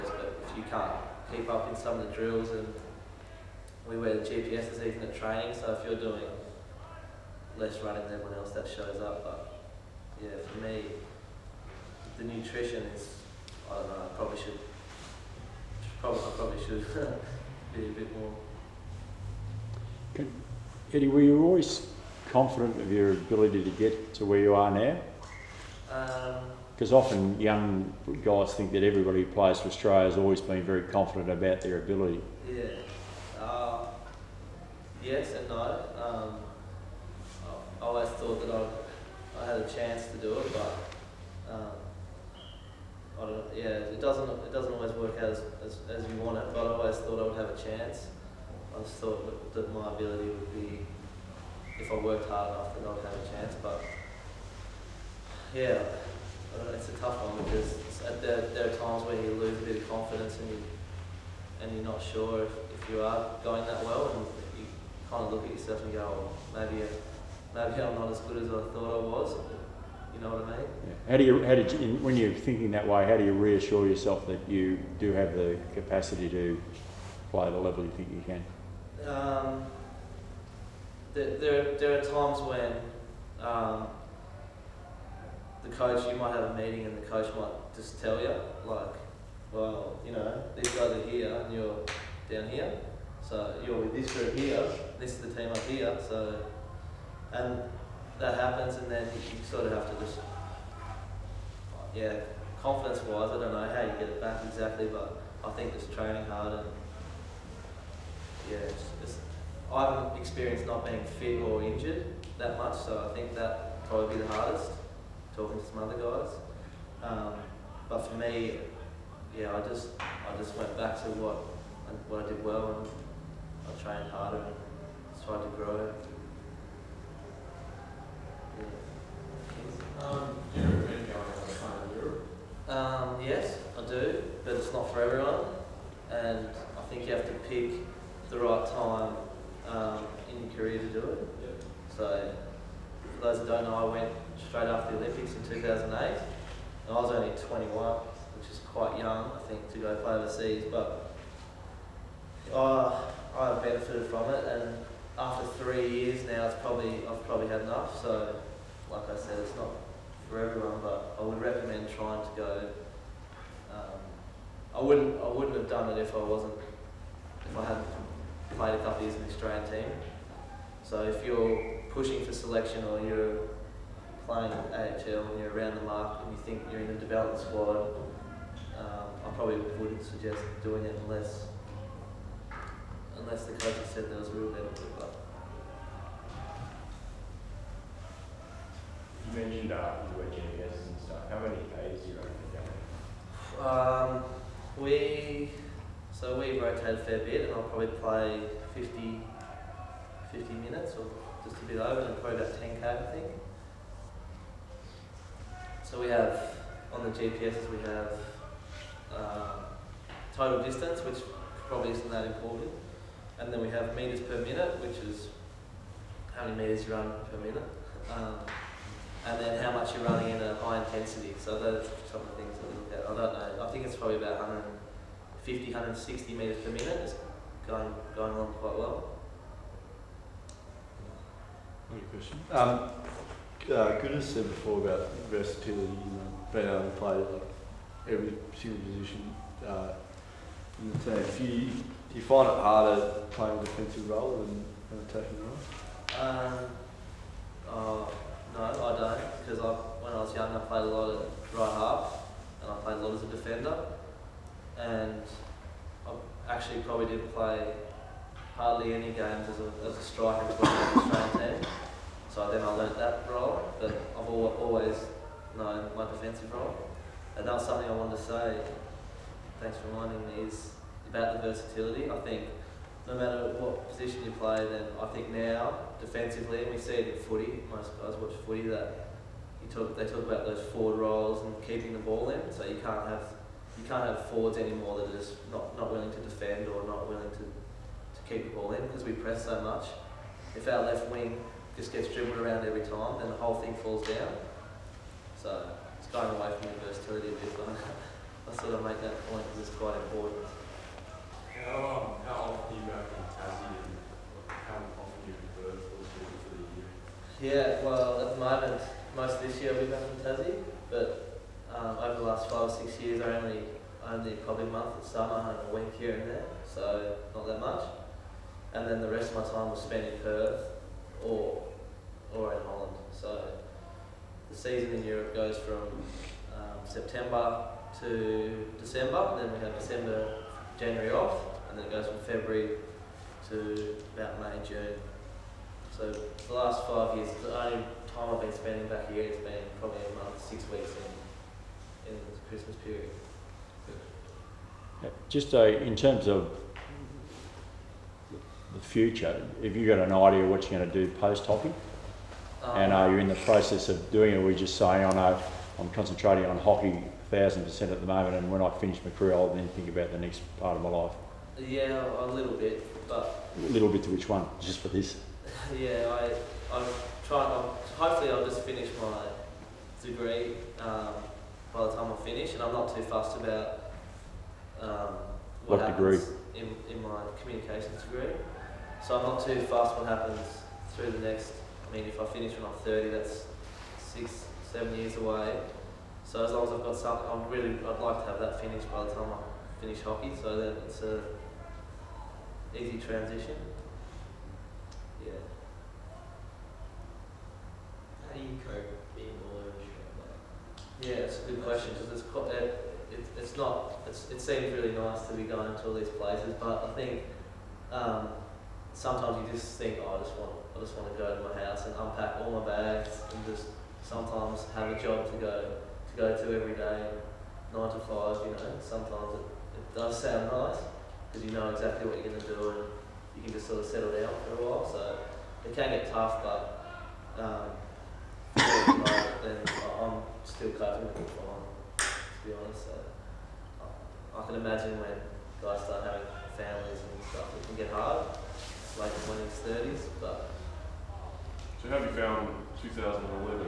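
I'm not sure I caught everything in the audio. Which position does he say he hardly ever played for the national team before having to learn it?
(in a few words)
Striker.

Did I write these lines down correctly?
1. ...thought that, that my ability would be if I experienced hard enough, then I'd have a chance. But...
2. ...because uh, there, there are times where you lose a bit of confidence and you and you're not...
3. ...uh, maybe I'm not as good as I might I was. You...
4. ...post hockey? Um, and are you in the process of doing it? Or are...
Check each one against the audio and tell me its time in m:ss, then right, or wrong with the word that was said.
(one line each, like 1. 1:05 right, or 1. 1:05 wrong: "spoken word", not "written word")
1. 0:48 wrong: "worked", not "experienced"
2. 0:57 right
3. 1:06 wrong: "thought", not "might"
4. 5:51 right.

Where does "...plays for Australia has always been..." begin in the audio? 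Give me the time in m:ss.
0:29.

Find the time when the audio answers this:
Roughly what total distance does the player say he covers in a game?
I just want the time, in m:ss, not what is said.
3:22.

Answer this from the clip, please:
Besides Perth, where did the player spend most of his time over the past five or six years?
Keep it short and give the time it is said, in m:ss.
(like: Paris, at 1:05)
Holland, at 5:22.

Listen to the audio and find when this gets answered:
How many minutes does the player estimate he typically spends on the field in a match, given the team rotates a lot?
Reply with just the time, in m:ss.
3:18.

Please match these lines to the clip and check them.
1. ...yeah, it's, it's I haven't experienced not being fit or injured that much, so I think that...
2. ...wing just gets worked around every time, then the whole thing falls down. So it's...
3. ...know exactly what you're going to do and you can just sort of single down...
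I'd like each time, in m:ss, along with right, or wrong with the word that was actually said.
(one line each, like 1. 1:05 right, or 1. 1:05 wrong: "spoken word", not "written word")
1. 1:48 right
2. 4:51 wrong: "dribbled", not "worked"
3. 7:01 wrong: "settle", not "single".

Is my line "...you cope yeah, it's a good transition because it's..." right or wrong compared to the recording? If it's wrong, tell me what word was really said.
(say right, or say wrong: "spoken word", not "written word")
wrong: "question", not "transition".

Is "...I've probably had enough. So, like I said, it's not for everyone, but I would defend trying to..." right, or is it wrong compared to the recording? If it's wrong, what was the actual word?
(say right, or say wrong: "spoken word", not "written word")
wrong: "recommend", not "defend".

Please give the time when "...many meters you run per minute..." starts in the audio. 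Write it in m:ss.
3:36.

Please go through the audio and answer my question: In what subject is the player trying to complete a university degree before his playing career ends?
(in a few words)
Communications.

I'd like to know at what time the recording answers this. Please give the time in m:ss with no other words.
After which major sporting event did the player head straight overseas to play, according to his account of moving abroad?
2:24.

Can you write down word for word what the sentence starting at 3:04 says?
But you mentioned uh, you were and stuff.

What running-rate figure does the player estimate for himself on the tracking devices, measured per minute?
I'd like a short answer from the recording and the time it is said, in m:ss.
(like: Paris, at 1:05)
150-160 metres per minute, at 3:44.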